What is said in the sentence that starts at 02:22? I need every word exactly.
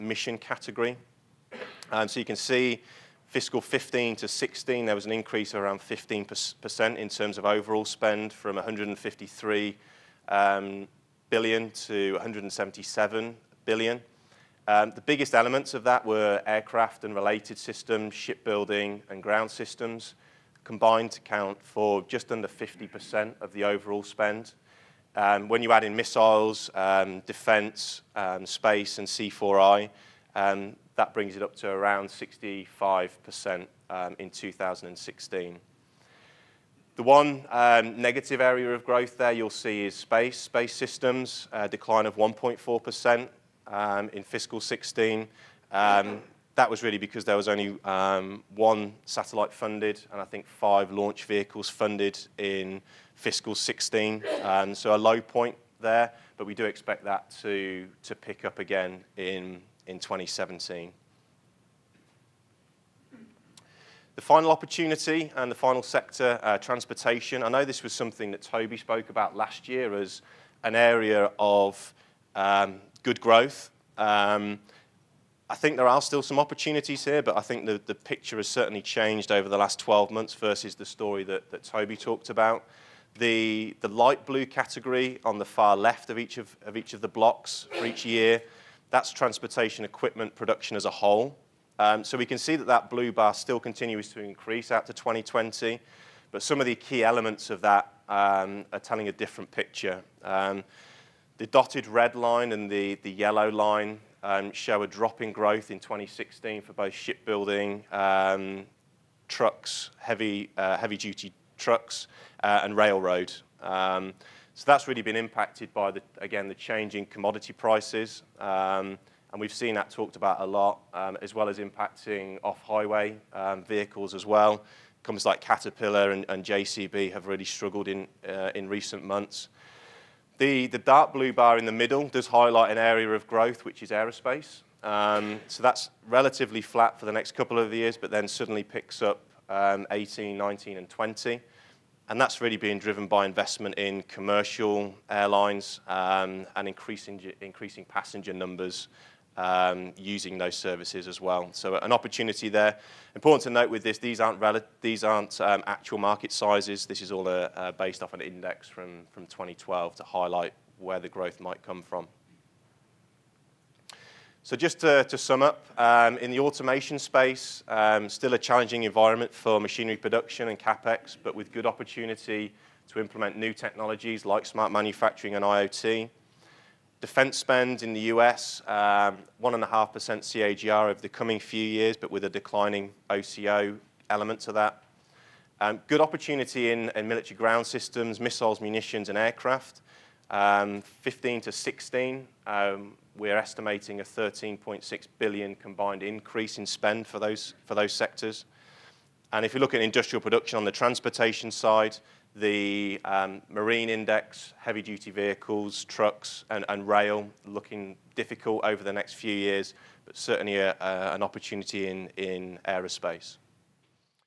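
And that's really being driven by investment in commercial airlines um, and increasing, increasing passenger numbers um, using those services as well.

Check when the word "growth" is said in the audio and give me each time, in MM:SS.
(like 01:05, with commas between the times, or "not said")
00:38, 01:13, 01:45, 02:13, 02:41.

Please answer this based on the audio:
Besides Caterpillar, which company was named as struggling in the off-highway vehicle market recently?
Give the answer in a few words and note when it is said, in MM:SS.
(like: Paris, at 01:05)
JCB, at 02:06.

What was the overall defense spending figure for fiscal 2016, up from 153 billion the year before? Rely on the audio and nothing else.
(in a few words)
177 billion.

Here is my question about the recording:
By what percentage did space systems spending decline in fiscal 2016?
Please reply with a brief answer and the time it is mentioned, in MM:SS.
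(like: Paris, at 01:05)
1.4%, at 00:42.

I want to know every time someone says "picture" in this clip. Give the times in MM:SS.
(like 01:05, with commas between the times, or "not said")
01:17, 01:39.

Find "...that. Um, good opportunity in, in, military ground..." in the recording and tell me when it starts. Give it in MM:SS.
03:04.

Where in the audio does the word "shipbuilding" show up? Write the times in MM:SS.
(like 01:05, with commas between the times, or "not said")
00:18, 01:46.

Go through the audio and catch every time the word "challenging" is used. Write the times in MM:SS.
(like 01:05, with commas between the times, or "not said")
02:48.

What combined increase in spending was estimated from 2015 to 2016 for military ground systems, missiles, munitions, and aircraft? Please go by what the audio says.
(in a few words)
13.6 billion.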